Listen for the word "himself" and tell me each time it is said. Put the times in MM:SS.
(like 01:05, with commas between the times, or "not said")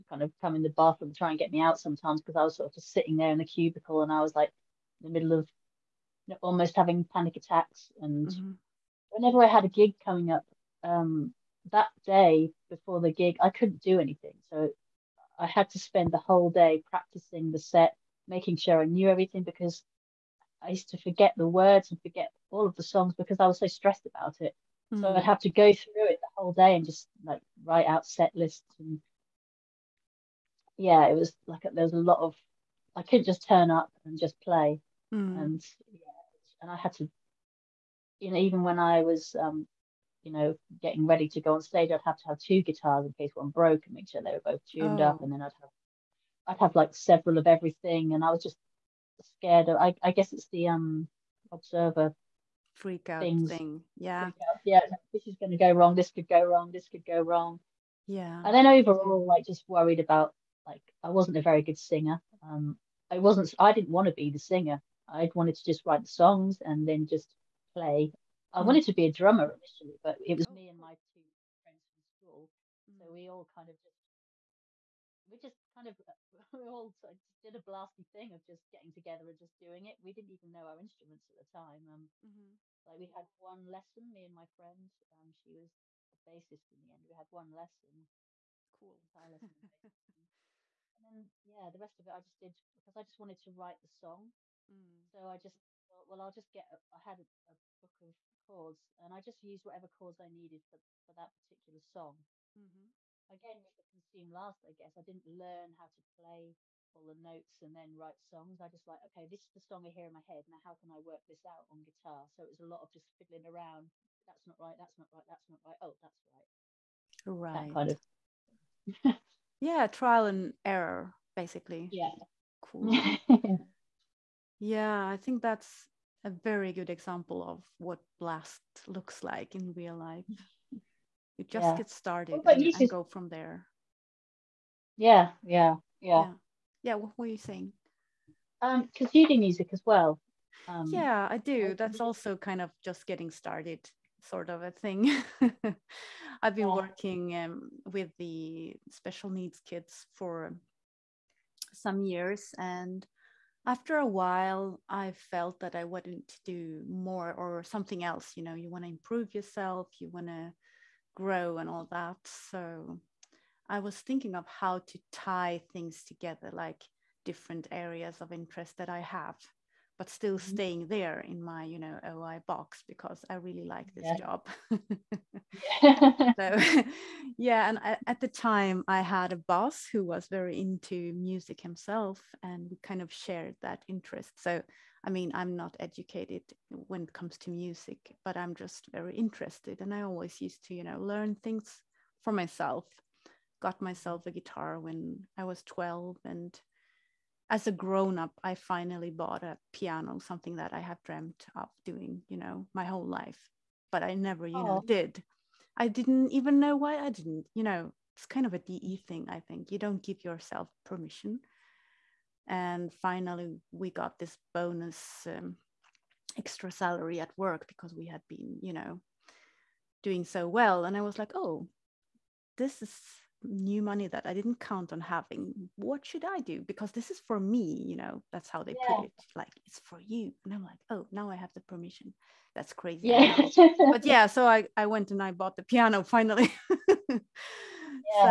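03:01.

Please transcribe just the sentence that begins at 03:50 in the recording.
And I'm like, oh, now I have the permission.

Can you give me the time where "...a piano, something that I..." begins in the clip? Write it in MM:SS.
03:19.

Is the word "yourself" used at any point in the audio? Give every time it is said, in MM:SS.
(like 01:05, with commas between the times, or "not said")
02:39, 03:30.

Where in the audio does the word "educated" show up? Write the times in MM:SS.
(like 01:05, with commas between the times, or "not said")
03:05.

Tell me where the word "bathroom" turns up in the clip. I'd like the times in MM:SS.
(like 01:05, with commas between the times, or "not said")
00:00.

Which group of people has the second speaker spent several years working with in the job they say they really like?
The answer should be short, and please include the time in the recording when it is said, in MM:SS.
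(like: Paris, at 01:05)
special needs kids, at 02:28.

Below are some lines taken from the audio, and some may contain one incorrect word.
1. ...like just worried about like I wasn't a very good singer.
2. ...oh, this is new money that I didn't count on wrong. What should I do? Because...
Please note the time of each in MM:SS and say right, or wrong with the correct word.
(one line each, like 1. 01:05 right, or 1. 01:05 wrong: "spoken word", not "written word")
1. 00:59 right
2. 03:41 wrong: "having", not "wrong".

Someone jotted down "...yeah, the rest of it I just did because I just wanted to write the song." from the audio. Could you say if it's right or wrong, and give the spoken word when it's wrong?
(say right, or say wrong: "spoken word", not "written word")
right.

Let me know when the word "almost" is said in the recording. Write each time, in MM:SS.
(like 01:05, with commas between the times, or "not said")
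00:06.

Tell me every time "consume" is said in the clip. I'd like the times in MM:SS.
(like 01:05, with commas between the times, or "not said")
01:43.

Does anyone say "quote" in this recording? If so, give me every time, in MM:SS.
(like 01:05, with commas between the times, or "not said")
not said.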